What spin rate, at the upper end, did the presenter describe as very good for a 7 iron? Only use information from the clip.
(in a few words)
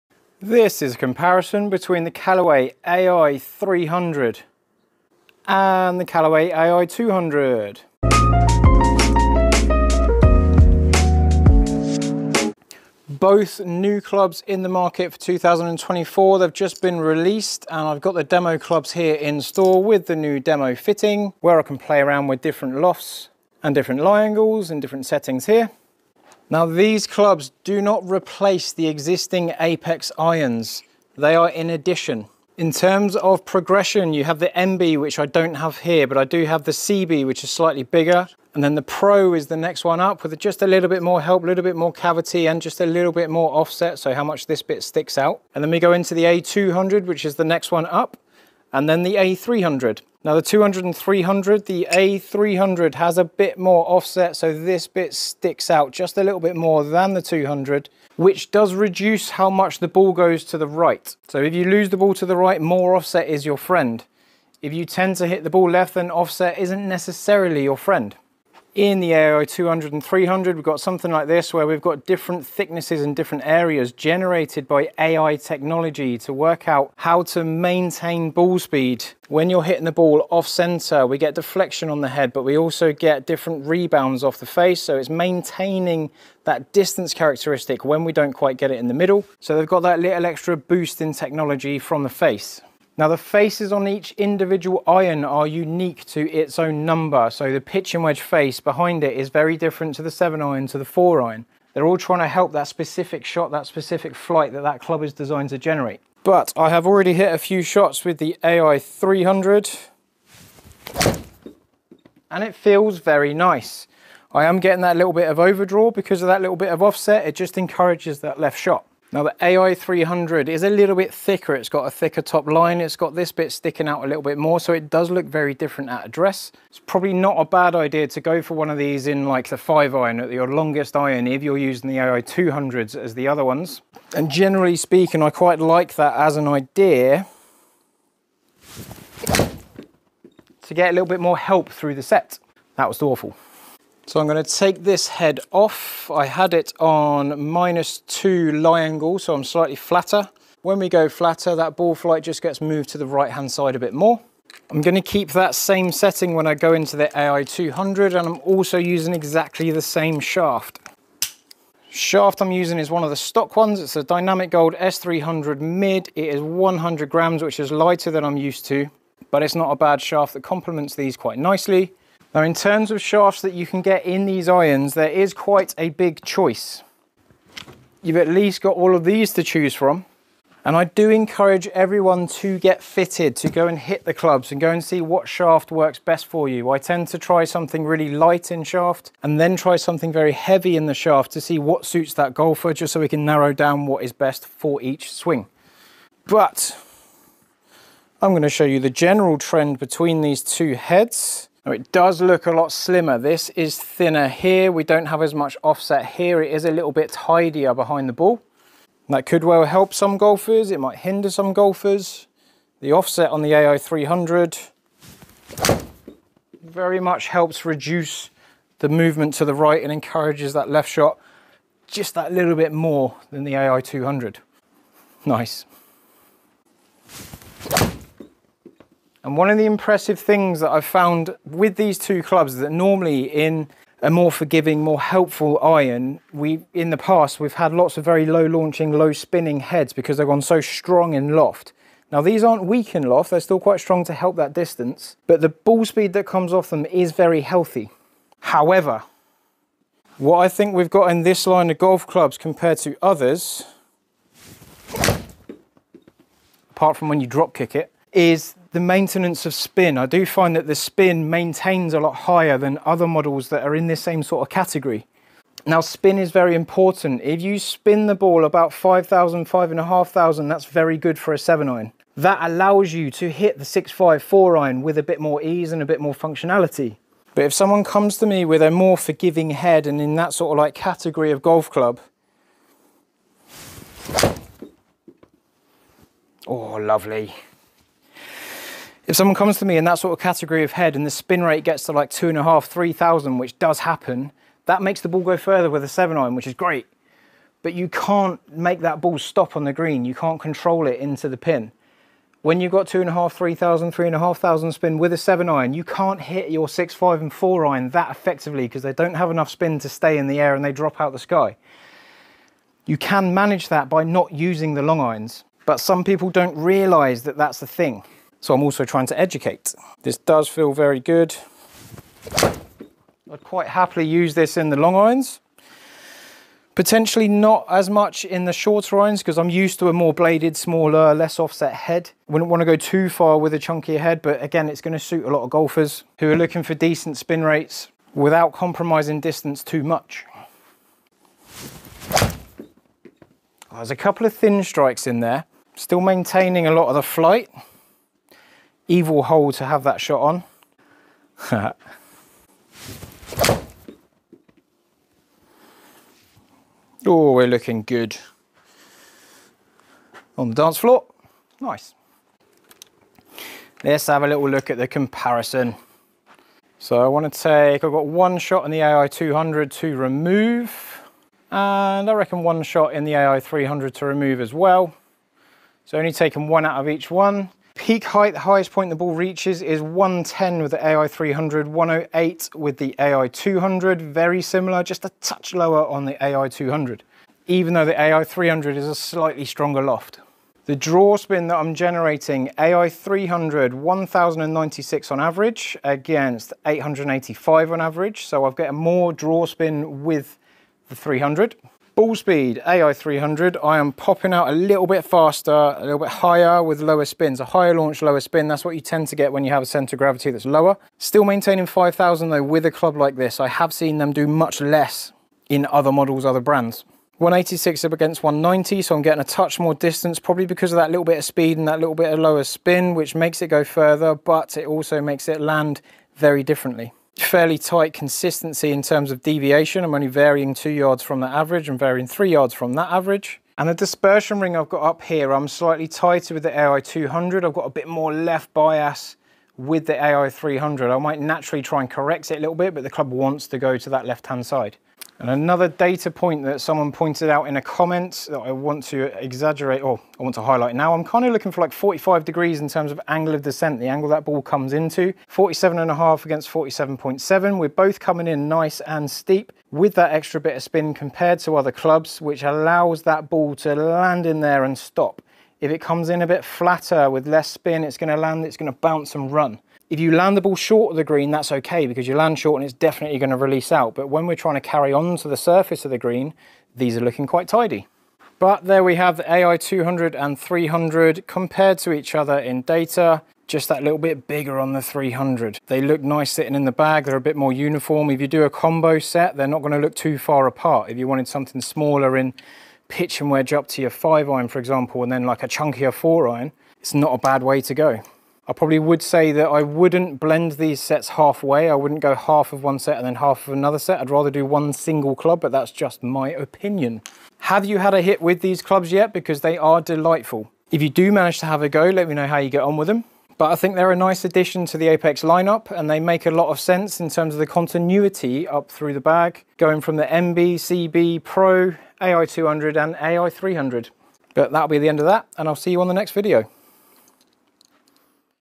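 5,500.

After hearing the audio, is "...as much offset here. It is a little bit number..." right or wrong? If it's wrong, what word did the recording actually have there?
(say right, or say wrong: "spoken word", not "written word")
wrong: "tidier", not "number".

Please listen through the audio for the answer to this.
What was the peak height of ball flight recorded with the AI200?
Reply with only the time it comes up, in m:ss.
6:21.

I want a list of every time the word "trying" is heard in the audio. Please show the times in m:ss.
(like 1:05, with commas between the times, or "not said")
1:41, 5:18, 7:54.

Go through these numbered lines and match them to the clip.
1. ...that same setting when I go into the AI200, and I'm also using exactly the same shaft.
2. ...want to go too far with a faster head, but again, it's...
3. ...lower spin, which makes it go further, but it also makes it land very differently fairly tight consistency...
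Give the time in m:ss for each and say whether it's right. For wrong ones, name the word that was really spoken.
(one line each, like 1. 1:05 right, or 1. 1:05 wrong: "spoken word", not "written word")
1. 2:35 right
2. 5:32 wrong: "chunkier", not "faster"
3. 7:02 right.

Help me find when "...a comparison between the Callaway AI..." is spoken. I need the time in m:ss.
0:00.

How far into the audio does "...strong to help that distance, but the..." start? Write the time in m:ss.
4:03.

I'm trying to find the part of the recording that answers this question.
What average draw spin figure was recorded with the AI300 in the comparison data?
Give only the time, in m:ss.
6:33.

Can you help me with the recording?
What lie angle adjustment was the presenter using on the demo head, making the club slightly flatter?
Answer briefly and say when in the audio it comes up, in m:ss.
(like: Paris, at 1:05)
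-2, at 2:27.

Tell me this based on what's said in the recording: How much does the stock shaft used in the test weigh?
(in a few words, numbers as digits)
100 grams.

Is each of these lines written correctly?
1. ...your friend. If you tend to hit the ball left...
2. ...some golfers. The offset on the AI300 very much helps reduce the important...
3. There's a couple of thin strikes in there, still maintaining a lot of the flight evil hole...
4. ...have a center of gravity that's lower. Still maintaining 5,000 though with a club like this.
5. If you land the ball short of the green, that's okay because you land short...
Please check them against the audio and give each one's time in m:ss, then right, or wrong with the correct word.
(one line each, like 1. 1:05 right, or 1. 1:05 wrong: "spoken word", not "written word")
1. 1:03 right
2. 3:31 wrong: "movement", not "important"
3. 5:43 right
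4. 6:49 right
5. 7:49 right.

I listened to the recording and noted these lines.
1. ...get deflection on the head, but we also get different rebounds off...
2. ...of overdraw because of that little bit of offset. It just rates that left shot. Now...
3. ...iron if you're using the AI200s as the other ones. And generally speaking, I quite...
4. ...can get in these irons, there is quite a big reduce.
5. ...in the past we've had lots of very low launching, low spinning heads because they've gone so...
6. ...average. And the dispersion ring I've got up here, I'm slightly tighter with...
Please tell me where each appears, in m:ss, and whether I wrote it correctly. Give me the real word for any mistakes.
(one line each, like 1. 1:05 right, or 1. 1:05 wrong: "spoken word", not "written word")
1. 1:21 right
2. 1:55 wrong: "encourages", not "rates"
3. 2:10 right
4. 2:53 wrong: "choice", not "reduce"
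5. 3:56 right
6. 7:12 right.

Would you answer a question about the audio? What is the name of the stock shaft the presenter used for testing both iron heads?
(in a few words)
Dynamic Gold S300.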